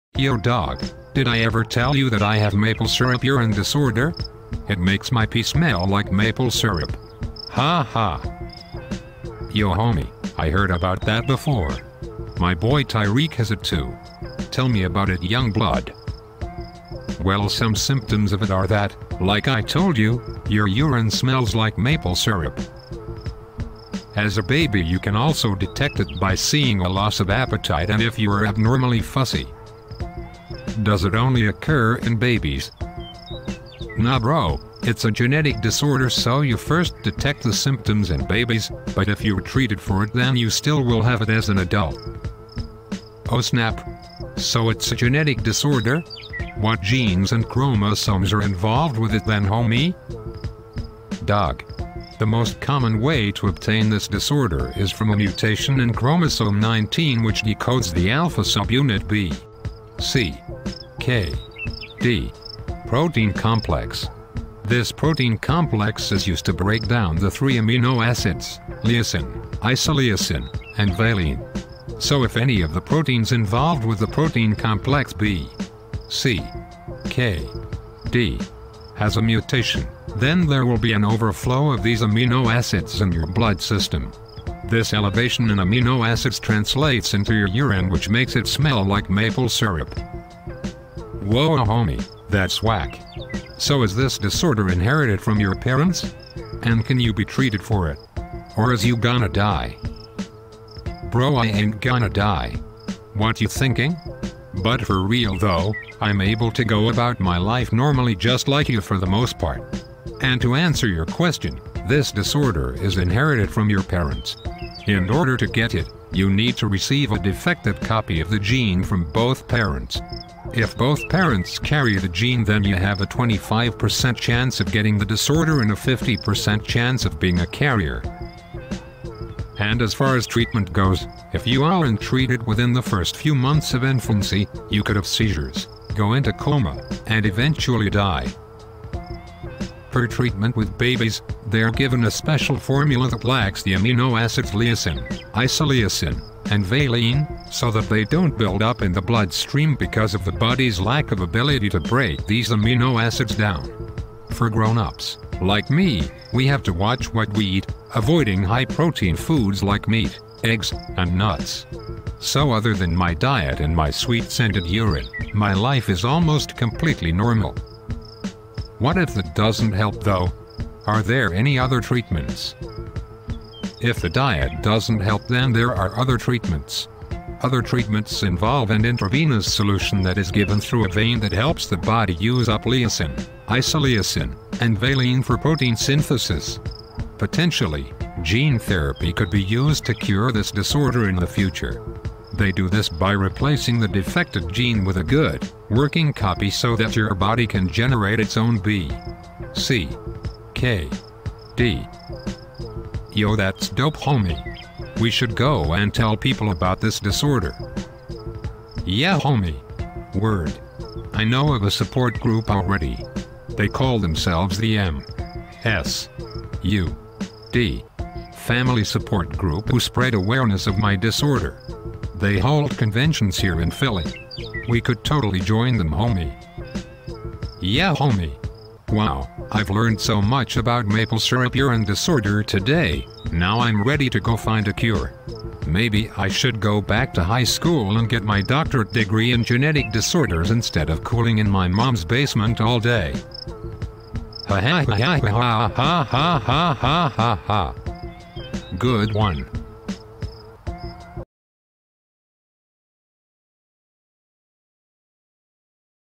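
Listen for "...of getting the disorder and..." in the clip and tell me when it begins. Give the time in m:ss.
2:04.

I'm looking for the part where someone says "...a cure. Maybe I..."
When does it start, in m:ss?
3:54.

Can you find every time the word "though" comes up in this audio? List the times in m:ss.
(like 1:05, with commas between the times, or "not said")
1:45, 2:50.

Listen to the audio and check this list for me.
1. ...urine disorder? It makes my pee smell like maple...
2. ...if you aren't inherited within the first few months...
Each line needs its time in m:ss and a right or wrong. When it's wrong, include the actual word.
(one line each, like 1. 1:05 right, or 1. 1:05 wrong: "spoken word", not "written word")
1. 0:03 right
2. 2:11 wrong: "treated", not "inherited".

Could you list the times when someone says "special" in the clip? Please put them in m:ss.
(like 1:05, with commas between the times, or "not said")
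2:22.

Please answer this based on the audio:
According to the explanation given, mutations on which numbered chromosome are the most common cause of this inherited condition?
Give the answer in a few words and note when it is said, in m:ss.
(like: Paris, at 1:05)
Chromosome 19, at 0:55.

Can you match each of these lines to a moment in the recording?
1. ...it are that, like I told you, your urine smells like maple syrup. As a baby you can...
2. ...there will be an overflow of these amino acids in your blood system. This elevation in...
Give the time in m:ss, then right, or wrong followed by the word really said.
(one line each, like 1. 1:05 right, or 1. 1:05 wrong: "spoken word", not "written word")
1. 0:18 right
2. 1:20 right.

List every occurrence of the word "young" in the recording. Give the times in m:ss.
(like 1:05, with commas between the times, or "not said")
0:15.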